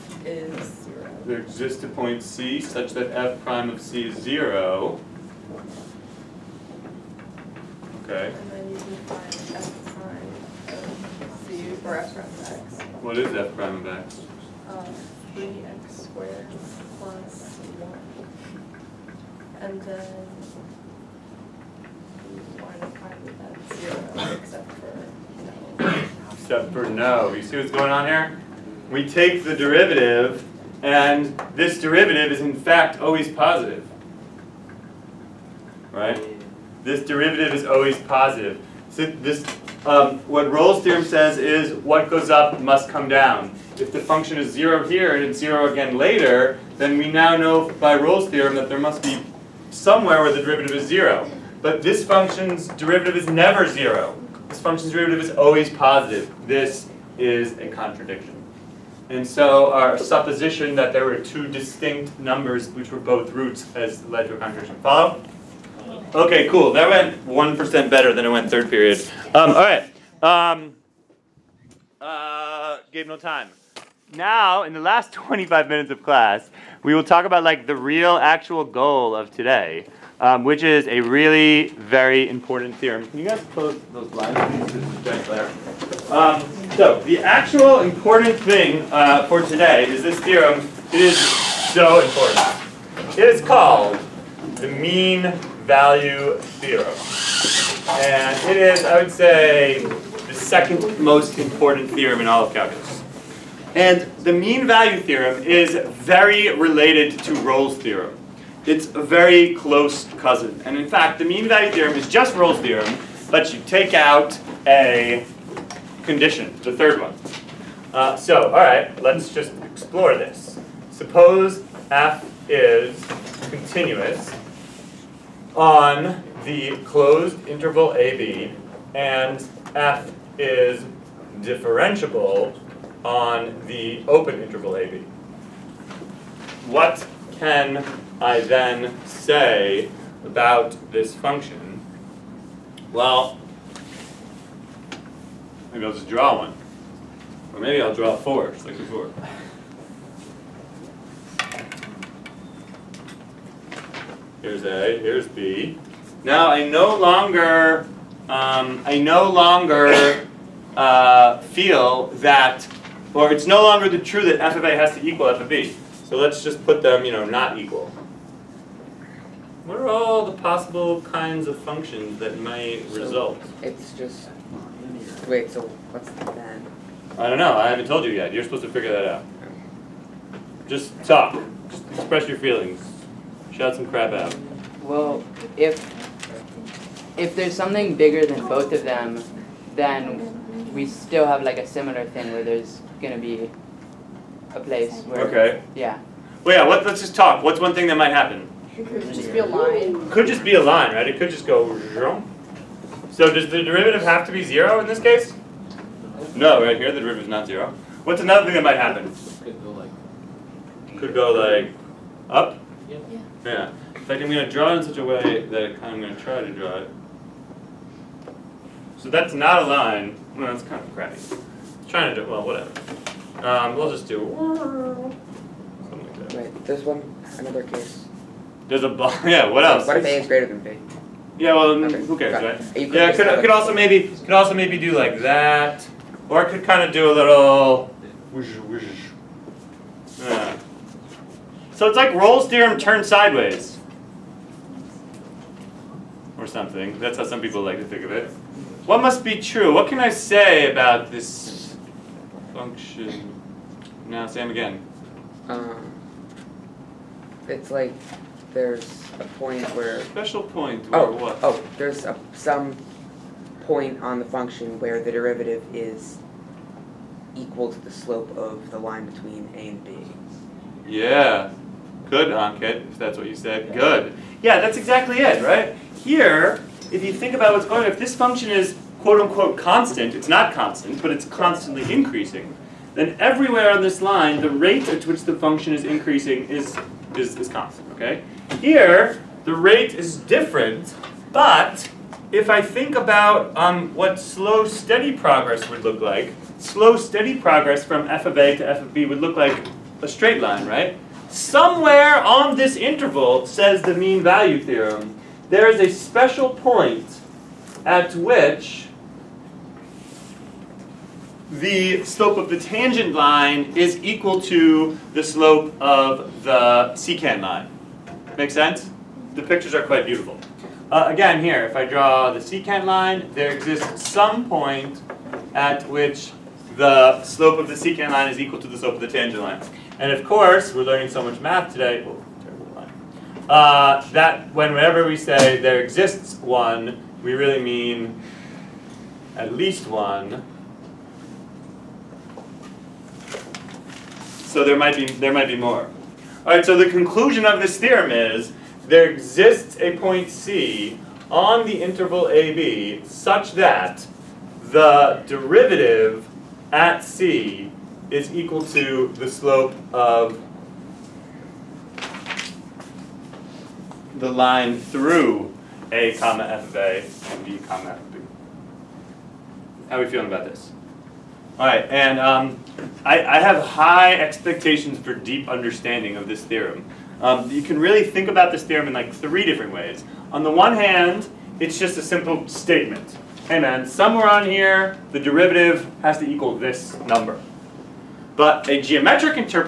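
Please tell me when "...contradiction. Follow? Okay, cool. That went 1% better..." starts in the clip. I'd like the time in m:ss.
1:04.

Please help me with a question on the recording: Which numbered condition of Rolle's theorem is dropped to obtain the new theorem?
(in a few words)
the third.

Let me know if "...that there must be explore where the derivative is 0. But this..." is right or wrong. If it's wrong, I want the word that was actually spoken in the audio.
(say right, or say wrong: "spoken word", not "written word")
wrong: "somewhere", not "explore".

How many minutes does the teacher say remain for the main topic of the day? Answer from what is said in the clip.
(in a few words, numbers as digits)
25.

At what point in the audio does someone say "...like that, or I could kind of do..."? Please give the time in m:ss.
3:54.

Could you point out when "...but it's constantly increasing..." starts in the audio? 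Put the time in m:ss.
4:41.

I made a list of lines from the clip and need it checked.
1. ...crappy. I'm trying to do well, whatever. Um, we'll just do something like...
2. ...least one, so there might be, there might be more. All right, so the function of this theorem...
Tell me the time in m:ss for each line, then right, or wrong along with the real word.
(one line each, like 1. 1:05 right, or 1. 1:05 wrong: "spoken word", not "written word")
1. 3:40 right
2. 5:39 wrong: "conclusion", not "function".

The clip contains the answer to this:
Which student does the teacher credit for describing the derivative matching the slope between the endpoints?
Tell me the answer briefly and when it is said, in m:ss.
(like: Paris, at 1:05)
Ankit, at 4:32.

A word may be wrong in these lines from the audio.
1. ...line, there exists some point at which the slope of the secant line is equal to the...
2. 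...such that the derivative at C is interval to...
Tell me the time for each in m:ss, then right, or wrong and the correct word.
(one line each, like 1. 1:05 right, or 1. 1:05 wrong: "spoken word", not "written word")
1. 5:22 right
2. 5:53 wrong: "equal", not "interval".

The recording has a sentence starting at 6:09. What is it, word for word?
How are we feeling about this?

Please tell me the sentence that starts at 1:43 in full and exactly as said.
And the mean value theorem is very related to Rolle's theorem.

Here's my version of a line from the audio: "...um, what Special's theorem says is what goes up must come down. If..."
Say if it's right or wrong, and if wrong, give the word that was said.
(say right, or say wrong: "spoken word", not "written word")
wrong: "Rolle", not "Special".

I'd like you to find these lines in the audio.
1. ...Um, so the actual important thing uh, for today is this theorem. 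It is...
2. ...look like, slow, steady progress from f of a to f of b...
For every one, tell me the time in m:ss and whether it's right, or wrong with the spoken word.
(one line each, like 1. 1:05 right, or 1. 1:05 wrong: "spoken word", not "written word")
1. 1:26 right
2. 4:55 right.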